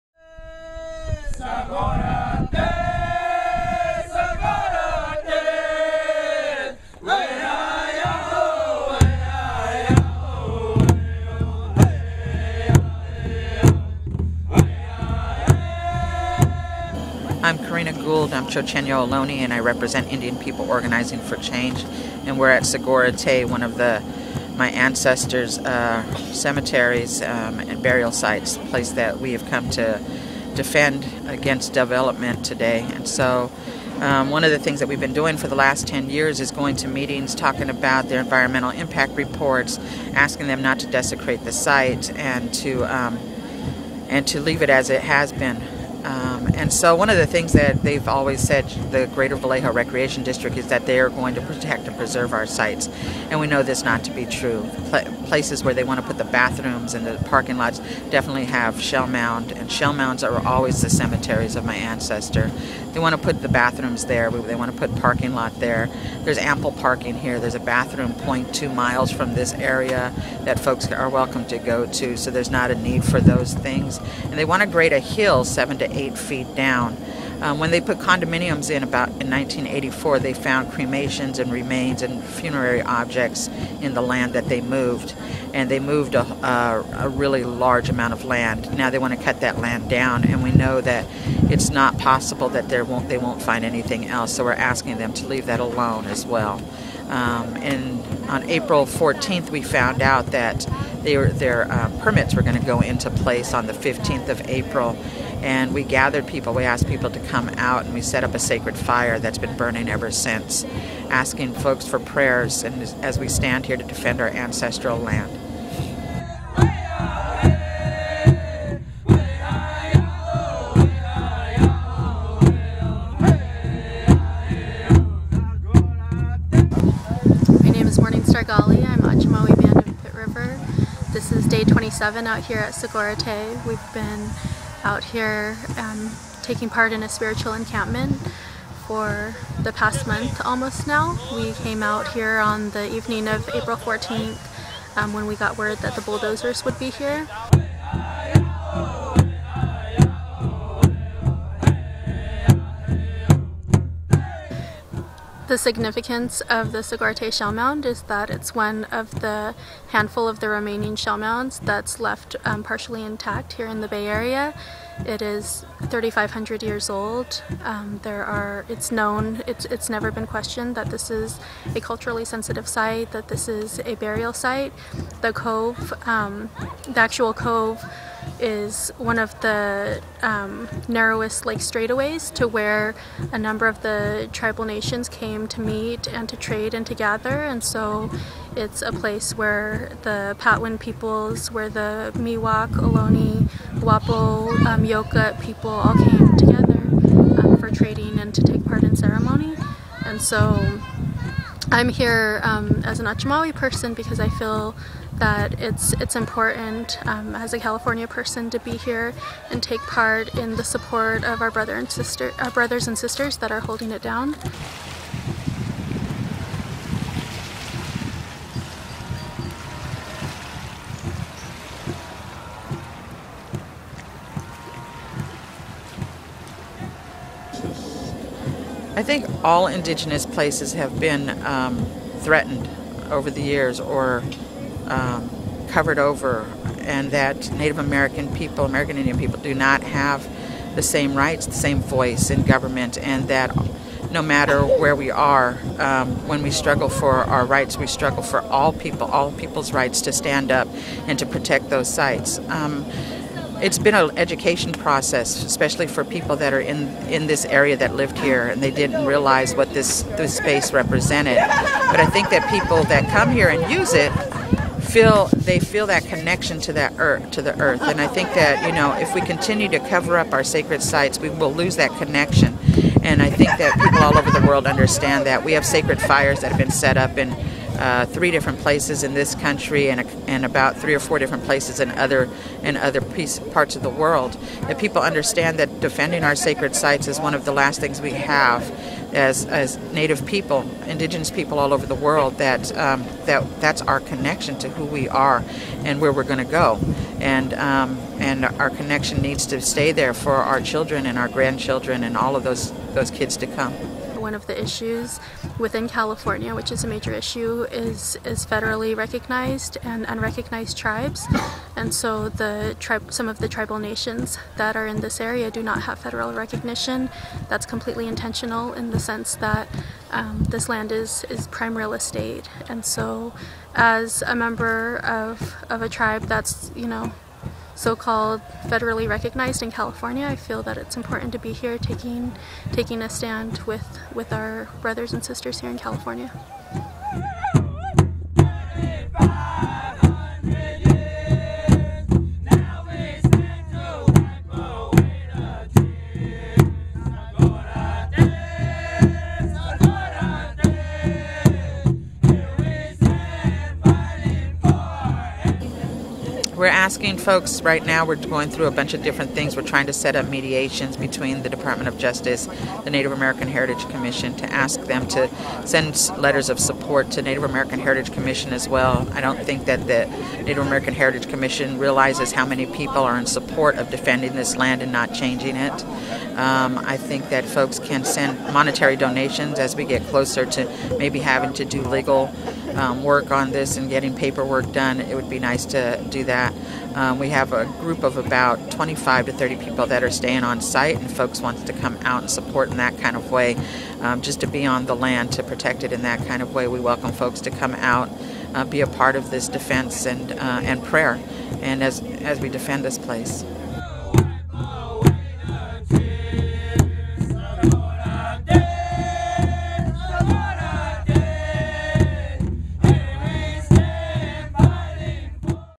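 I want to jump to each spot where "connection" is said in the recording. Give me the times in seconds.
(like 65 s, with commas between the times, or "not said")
266 s, 271 s, 293 s, 298 s.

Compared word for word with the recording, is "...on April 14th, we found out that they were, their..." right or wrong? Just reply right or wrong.
right.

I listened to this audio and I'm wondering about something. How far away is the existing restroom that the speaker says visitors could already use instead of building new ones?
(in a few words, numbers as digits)
0.2 miles.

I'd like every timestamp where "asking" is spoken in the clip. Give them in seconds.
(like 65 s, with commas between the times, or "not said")
40 s, 94 s, 111 s, 356 s.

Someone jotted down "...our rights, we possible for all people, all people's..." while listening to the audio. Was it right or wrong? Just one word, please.
wrong.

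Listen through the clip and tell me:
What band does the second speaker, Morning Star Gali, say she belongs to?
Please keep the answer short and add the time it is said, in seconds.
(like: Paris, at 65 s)
Achumawi Band of Pit River, at 128 s.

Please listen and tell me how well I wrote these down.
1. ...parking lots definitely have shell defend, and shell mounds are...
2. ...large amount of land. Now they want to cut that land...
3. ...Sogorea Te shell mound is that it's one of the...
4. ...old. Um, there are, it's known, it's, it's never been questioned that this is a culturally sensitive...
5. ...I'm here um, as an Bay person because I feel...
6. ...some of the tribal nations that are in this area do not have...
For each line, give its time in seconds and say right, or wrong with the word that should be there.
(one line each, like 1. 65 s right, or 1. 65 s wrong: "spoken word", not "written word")
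1. 57 s wrong: "mound", not "defend"
2. 87 s right
3. 156 s right
4. 166 s right
5. 201 s wrong: "Achumawi", not "Bay"
6. 313 s right.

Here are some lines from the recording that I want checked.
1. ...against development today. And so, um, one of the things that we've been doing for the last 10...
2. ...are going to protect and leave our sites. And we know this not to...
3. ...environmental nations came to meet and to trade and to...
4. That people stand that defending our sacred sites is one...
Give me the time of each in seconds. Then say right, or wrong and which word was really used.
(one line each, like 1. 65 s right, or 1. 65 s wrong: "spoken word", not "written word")
1. 31 s right
2. 50 s wrong: "preserve", not "leave"
3. 184 s wrong: "tribal", not "environmental"
4. 284 s wrong: "understand", not "stand".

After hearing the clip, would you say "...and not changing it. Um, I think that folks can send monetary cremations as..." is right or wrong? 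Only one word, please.
wrong.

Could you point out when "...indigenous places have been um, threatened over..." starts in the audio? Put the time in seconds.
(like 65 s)
229 s.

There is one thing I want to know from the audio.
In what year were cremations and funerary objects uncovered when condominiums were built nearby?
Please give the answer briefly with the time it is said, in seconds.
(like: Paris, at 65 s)
1984, at 79 s.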